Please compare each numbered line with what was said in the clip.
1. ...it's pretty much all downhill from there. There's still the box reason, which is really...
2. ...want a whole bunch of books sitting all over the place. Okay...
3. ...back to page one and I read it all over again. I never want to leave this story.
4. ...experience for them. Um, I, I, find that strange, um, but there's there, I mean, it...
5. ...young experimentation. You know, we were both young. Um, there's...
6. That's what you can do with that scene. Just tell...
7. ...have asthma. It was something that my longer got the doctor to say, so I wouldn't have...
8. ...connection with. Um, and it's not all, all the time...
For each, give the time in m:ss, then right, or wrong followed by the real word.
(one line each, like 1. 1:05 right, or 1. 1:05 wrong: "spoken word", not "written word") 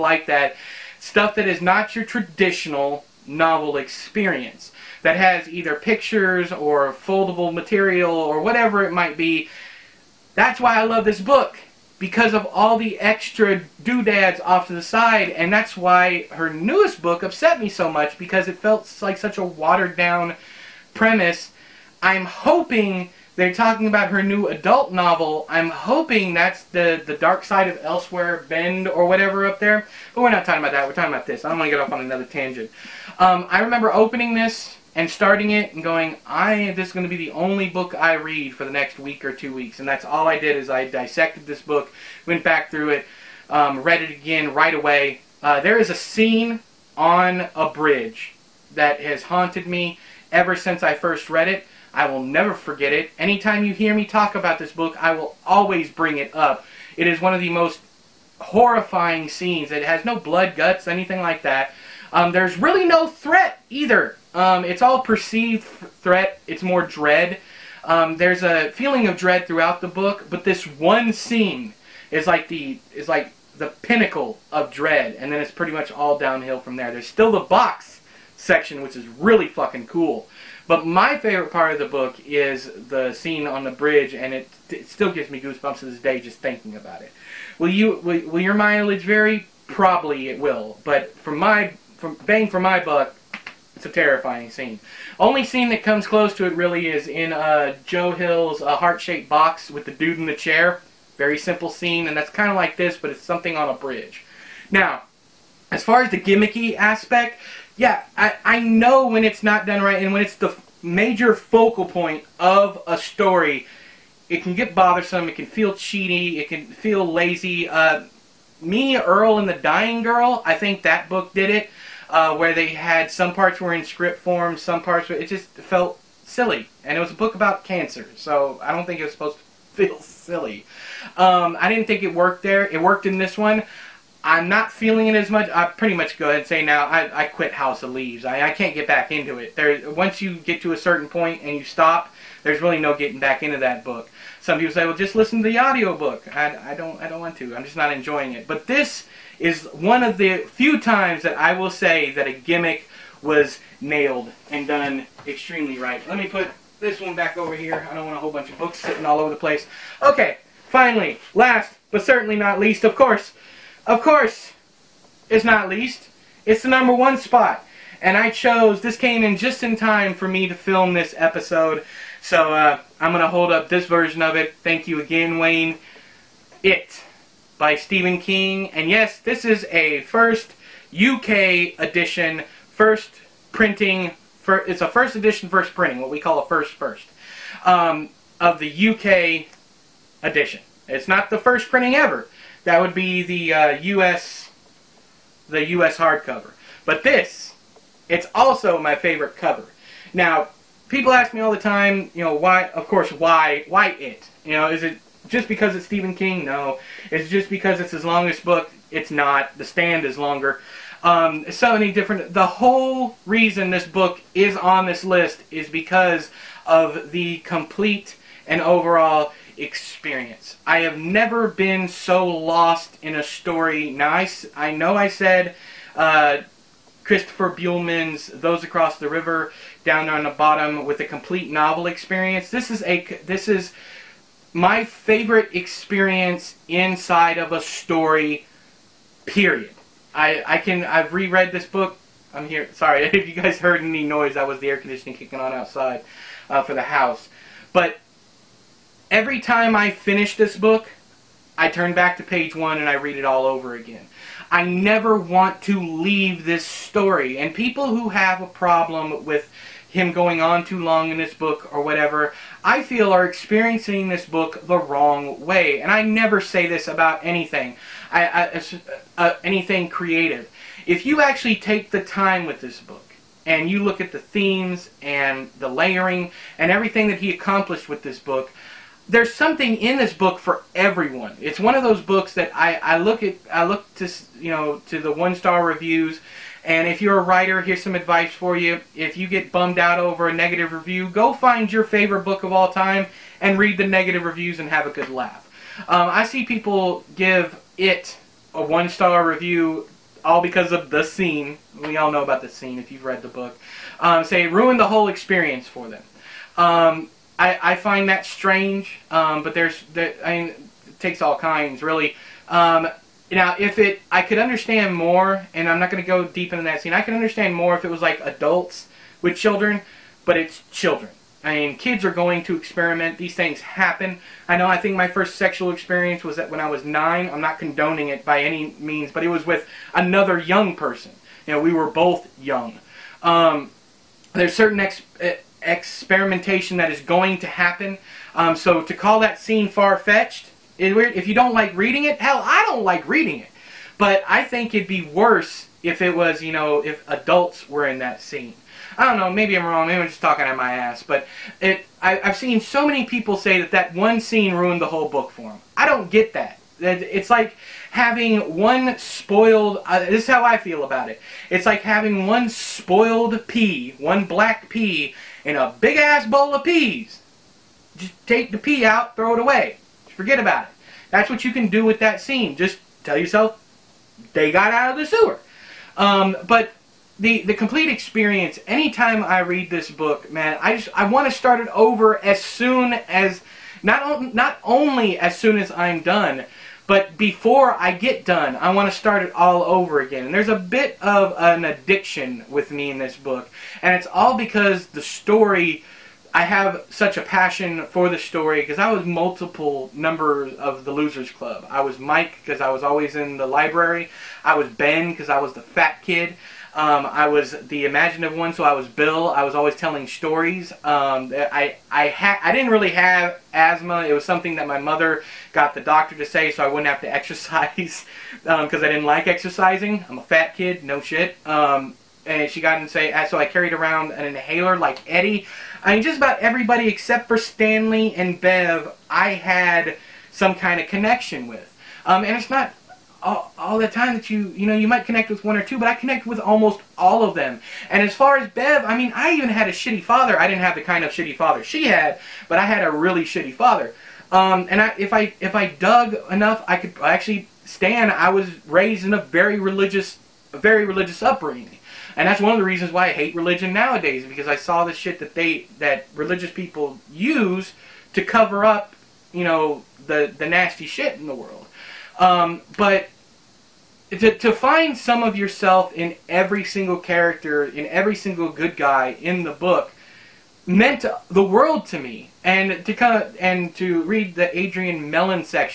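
1. 1:15 wrong: "section", not "reason"
2. 2:38 right
3. 4:11 right
4. 5:05 right
5. 5:30 wrong: "person", not "experimentation"
6. 6:11 right
7. 6:52 wrong: "mother", not "longer"
8. 7:10 right.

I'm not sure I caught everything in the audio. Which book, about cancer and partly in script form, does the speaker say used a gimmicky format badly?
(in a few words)
Me, Earl, and the Dying Girl.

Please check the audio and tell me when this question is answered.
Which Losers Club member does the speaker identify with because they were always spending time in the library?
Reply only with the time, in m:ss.
6:41.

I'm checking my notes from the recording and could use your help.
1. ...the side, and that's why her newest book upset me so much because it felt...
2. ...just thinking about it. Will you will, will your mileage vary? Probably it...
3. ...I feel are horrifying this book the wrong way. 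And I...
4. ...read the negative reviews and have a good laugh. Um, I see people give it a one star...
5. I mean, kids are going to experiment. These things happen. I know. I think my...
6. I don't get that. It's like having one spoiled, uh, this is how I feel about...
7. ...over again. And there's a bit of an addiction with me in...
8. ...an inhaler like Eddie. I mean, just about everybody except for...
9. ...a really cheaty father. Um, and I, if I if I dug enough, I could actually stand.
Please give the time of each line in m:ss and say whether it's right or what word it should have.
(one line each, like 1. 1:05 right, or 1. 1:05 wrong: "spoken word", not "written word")
1. 0:14 right
2. 1:26 right
3. 4:22 wrong: "experiencing", not "horrifying"
4. 4:53 right
5. 5:21 right
6. 5:55 right
7. 6:29 right
8. 7:04 right
9. 7:22 wrong: "shitty", not "cheaty".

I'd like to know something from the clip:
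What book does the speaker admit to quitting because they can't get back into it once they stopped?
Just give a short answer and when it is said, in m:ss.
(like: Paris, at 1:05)
House of Leaves, at 2:17.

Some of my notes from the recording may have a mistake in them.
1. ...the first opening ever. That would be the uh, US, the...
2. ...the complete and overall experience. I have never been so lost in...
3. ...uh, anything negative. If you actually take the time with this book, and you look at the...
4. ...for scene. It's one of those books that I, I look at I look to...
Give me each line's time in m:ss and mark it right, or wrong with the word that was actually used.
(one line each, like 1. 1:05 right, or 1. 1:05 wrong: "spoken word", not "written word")
1. 3:11 wrong: "printing", not "opening"
2. 3:37 right
3. 4:29 wrong: "creative", not "negative"
4. 4:40 wrong: "everyone", not "scene".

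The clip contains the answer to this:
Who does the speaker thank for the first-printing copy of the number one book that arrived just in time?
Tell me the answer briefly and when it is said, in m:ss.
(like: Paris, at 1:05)
Wayne, at 2:55.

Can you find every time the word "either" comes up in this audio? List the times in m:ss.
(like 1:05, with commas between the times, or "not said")
0:05, 1:03.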